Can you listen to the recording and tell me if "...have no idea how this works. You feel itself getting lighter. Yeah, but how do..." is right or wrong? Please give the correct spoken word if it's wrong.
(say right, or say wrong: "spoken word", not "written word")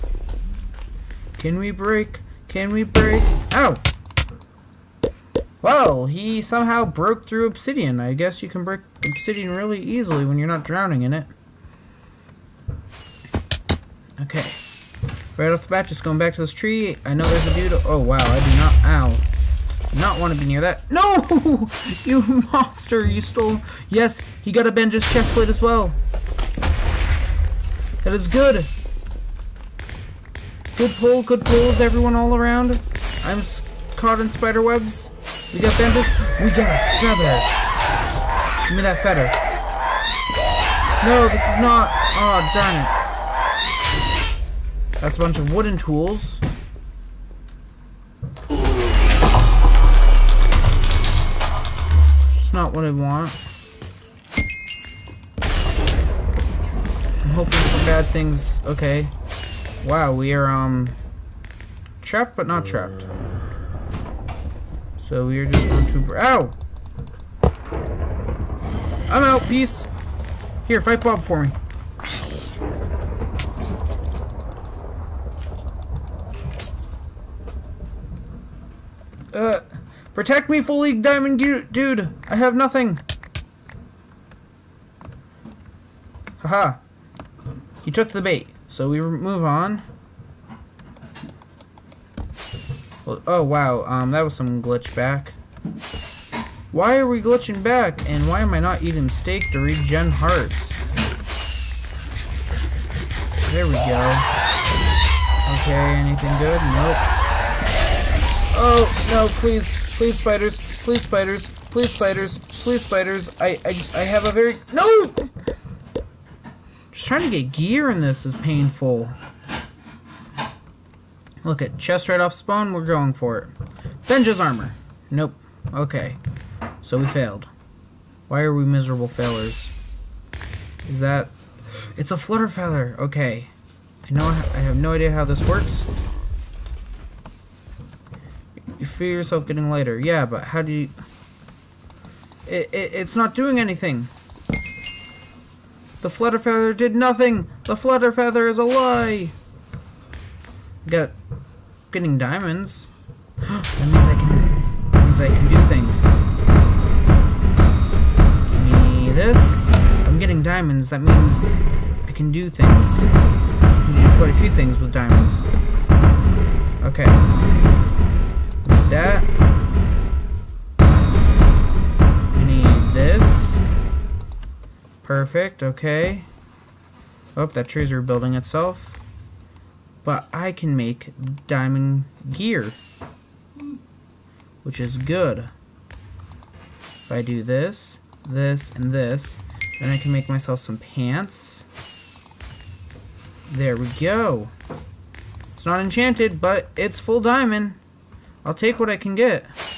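wrong: "yourself", not "itself".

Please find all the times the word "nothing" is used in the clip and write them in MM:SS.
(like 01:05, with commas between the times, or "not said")
01:22, 02:26.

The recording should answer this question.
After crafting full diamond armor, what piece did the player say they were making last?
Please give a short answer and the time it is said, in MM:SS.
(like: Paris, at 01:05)
pants, at 03:10.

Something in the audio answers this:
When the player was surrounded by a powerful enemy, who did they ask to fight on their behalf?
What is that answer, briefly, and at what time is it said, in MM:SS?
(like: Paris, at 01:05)
Bob, at 01:11.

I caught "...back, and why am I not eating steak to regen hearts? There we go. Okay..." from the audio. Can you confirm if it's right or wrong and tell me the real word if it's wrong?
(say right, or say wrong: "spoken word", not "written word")
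right.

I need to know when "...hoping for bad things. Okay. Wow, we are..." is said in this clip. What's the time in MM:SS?
00:57.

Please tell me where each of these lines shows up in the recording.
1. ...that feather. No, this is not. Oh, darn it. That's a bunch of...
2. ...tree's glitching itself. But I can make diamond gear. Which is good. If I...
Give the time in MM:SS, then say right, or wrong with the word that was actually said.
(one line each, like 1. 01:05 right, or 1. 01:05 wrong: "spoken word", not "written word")
1. 00:38 right
2. 02:57 wrong: "rebuilding", not "glitching".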